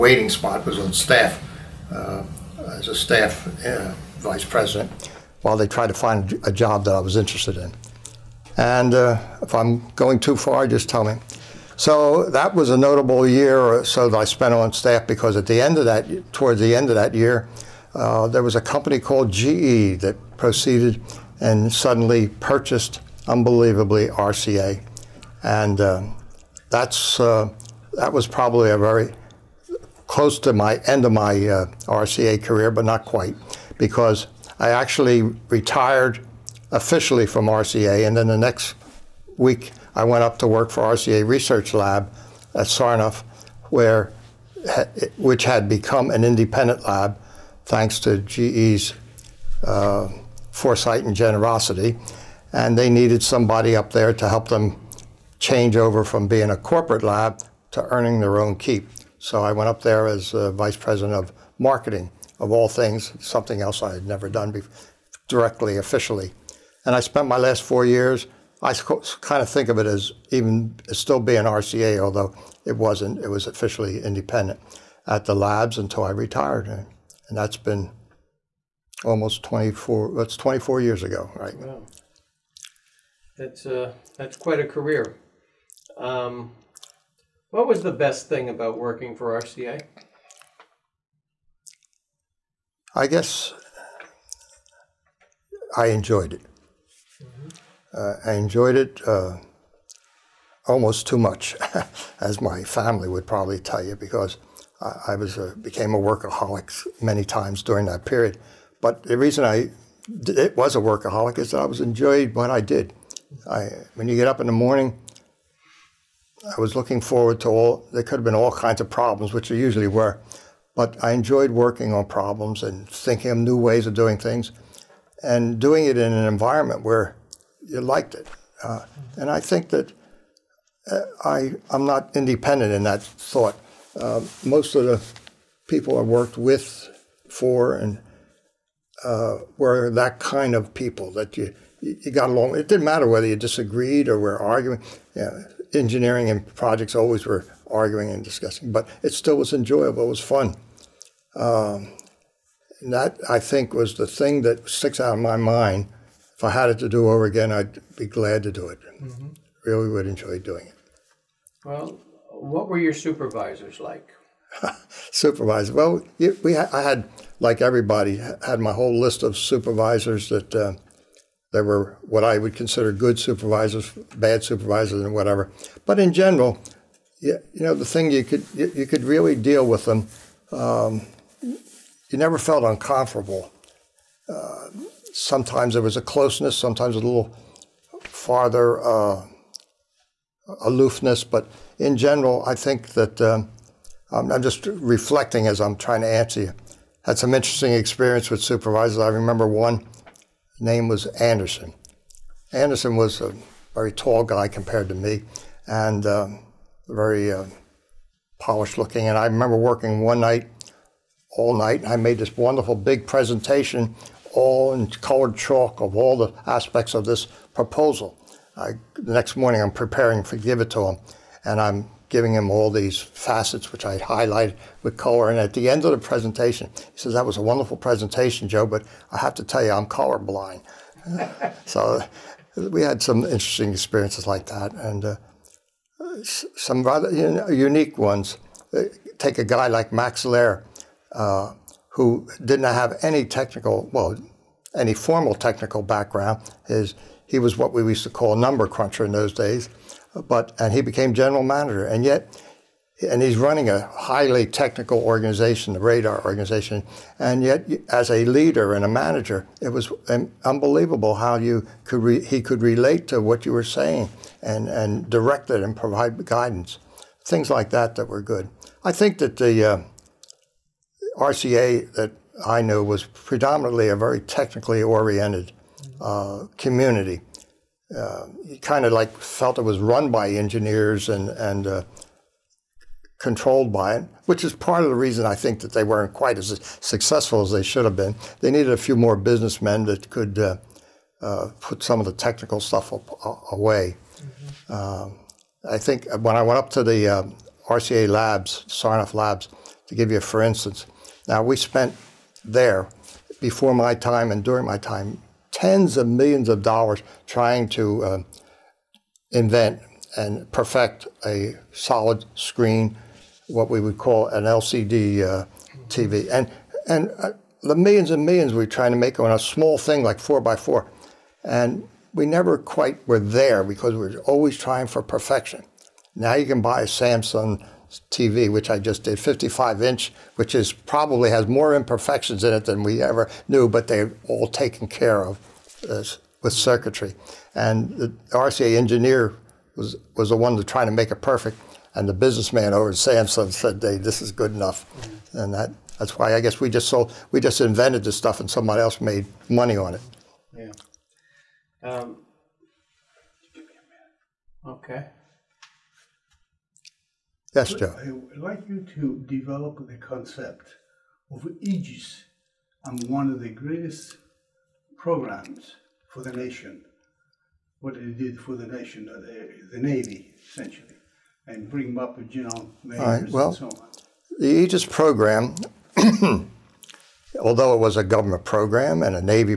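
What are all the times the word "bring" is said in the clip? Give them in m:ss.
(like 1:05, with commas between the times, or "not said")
6:11.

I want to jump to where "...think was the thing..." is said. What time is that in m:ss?
2:33.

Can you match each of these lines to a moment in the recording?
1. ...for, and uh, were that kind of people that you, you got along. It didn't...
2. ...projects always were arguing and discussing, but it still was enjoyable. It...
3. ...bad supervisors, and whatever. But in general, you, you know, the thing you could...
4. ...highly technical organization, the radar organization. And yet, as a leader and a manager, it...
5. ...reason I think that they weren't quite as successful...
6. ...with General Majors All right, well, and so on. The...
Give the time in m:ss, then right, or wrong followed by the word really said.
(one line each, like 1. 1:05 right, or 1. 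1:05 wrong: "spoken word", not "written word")
1. 2:17 right
2. 2:26 right
3. 2:54 right
4. 4:13 right
5. 4:44 right
6. 6:12 right.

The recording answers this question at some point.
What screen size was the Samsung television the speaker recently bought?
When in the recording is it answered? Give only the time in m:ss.
5:29.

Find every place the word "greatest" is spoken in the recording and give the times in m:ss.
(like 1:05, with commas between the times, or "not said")
6:03.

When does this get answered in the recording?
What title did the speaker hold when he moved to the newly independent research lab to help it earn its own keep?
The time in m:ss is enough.
1:00.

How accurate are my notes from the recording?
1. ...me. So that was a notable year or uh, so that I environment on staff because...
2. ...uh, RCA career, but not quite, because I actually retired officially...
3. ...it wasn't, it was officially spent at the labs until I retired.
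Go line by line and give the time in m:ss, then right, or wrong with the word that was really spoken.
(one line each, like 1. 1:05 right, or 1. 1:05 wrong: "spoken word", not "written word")
1. 0:11 wrong: "spent", not "environment"
2. 0:31 right
3. 1:12 wrong: "independent", not "spent".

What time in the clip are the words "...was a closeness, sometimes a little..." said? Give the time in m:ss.
3:05.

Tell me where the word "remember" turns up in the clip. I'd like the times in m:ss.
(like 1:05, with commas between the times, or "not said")
3:19, 3:29.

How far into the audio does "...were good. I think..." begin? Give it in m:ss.
4:28.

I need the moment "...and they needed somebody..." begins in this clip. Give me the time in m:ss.
0:52.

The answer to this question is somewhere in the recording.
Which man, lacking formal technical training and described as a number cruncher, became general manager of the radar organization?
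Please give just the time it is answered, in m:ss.
3:59.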